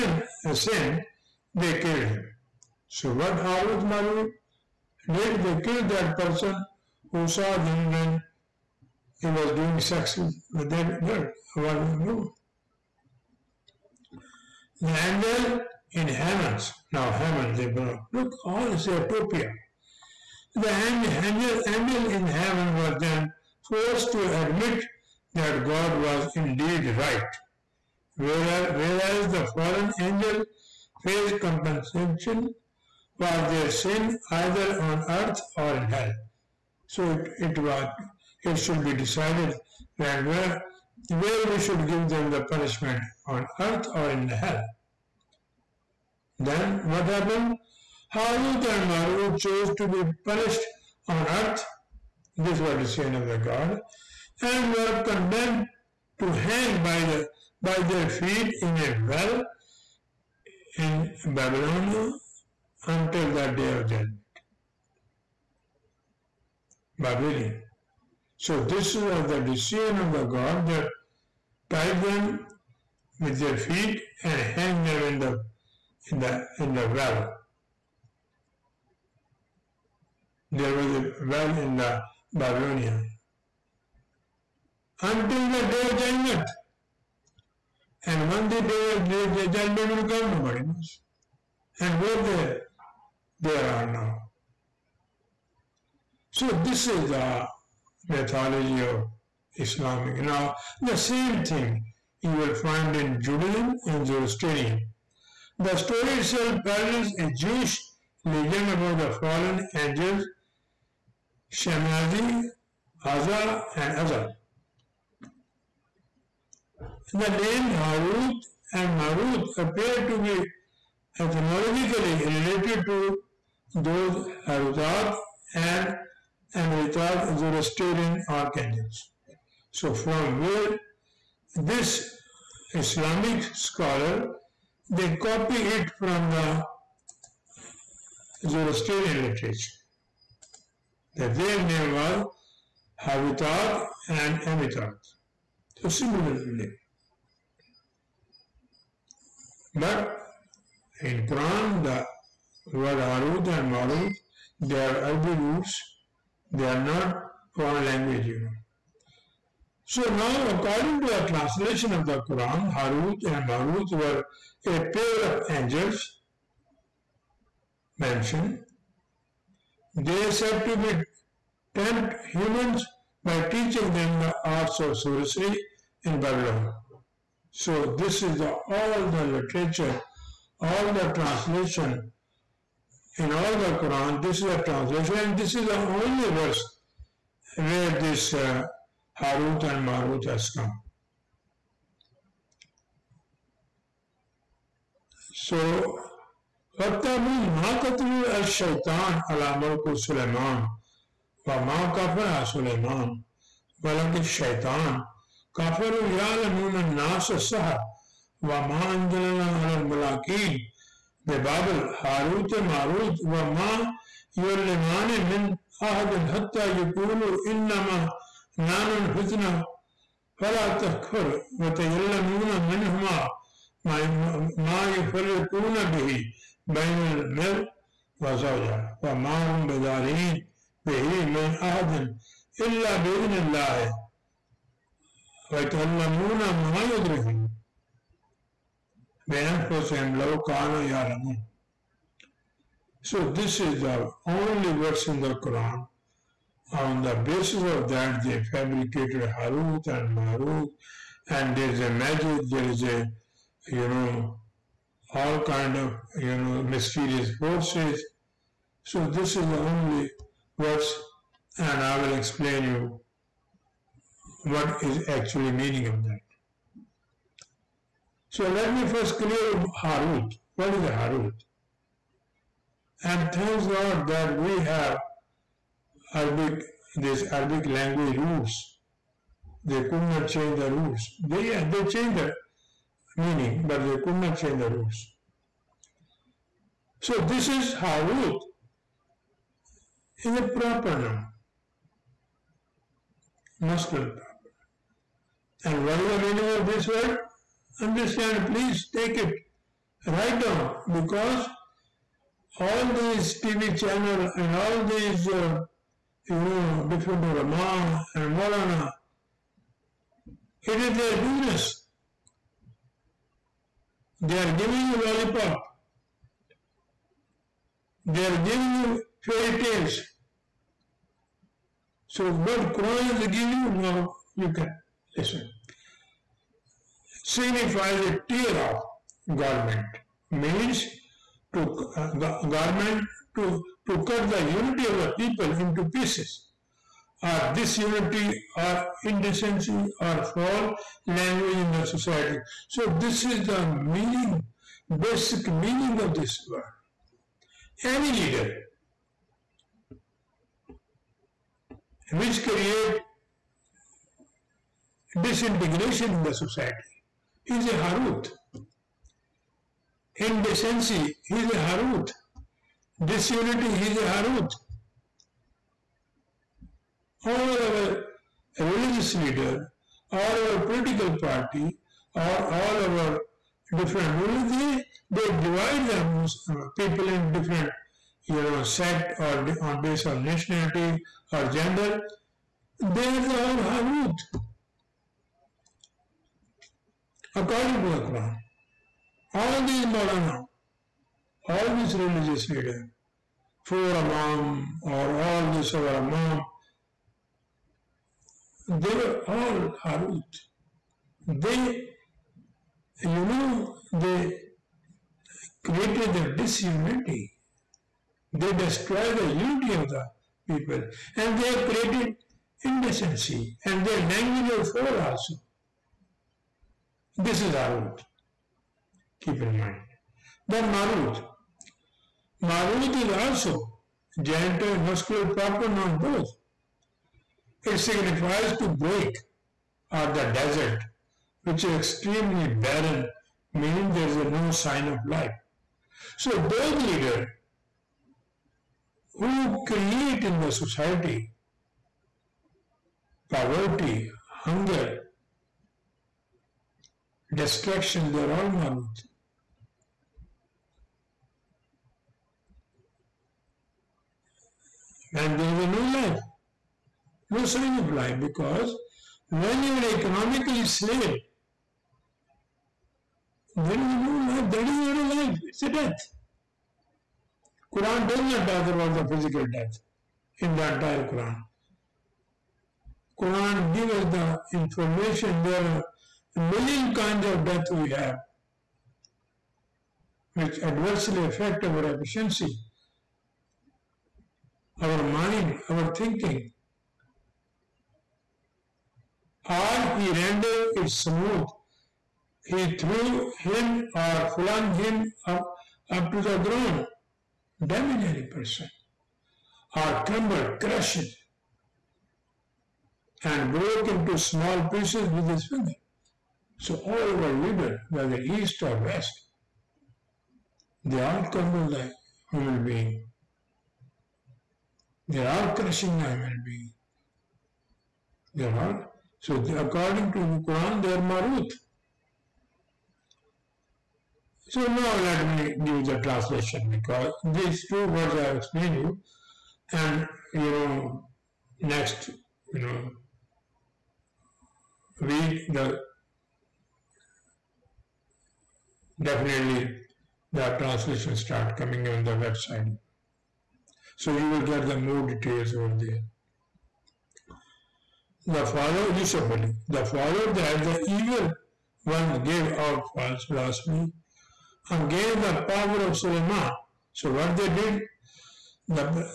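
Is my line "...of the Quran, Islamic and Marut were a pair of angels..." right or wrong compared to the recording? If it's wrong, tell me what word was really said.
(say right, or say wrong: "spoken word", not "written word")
wrong: "Harut", not "Islamic".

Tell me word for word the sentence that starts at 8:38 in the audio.
They're all so according to the Quran, they are Marut.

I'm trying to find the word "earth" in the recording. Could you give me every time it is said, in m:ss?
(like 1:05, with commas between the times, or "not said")
0:35, 0:43, 0:51.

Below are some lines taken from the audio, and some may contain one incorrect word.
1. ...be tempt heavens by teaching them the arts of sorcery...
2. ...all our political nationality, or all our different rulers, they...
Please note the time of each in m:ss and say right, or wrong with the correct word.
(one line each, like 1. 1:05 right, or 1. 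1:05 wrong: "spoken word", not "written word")
1. 2:50 wrong: "humans", not "heavens"
2. 6:10 wrong: "party", not "nationality".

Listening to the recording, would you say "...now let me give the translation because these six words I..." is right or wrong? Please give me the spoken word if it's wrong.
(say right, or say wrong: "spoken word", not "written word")
wrong: "two", not "six".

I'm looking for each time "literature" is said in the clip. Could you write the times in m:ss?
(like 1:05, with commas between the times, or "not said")
2:19, 2:59.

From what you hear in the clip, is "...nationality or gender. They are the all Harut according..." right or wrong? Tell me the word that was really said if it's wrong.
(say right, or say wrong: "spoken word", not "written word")
right.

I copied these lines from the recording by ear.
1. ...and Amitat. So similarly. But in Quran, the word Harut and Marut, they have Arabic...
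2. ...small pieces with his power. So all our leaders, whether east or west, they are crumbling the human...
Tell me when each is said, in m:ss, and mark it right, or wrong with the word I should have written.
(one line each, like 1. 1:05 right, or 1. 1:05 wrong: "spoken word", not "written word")
1. 2:24 right
2. 8:24 wrong: "finger", not "power".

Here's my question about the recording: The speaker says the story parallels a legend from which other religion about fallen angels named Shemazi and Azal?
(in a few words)
Jewish.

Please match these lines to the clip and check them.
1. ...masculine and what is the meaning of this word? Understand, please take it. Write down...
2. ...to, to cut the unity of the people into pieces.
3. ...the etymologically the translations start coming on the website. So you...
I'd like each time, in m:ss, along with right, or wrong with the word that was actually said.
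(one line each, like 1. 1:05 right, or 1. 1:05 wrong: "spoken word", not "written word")
1. 4:53 right
2. 5:33 right
3. 8:55 wrong: "definitely", not "etymologically".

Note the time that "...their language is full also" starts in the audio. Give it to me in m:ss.
6:53.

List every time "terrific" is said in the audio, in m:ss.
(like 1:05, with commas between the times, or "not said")
not said.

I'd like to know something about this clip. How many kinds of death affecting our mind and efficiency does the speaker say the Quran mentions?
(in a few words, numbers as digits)
A million.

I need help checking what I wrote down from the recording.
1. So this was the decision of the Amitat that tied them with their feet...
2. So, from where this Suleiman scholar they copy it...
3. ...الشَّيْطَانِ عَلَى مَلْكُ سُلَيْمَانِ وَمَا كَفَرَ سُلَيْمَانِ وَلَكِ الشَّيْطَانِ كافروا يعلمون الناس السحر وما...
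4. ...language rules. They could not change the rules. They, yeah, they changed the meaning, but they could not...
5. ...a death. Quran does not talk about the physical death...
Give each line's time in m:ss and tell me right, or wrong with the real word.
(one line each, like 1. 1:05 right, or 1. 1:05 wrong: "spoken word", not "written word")
1. 1:08 wrong: "God", not "Amitat"
2. 2:09 wrong: "Islamic", not "Suleiman"
3. 3:18 right
4. 4:37 right
5. 7:45 right.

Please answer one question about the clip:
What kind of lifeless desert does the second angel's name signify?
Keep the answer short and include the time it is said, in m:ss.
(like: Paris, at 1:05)
Extremely barren, at 7:11.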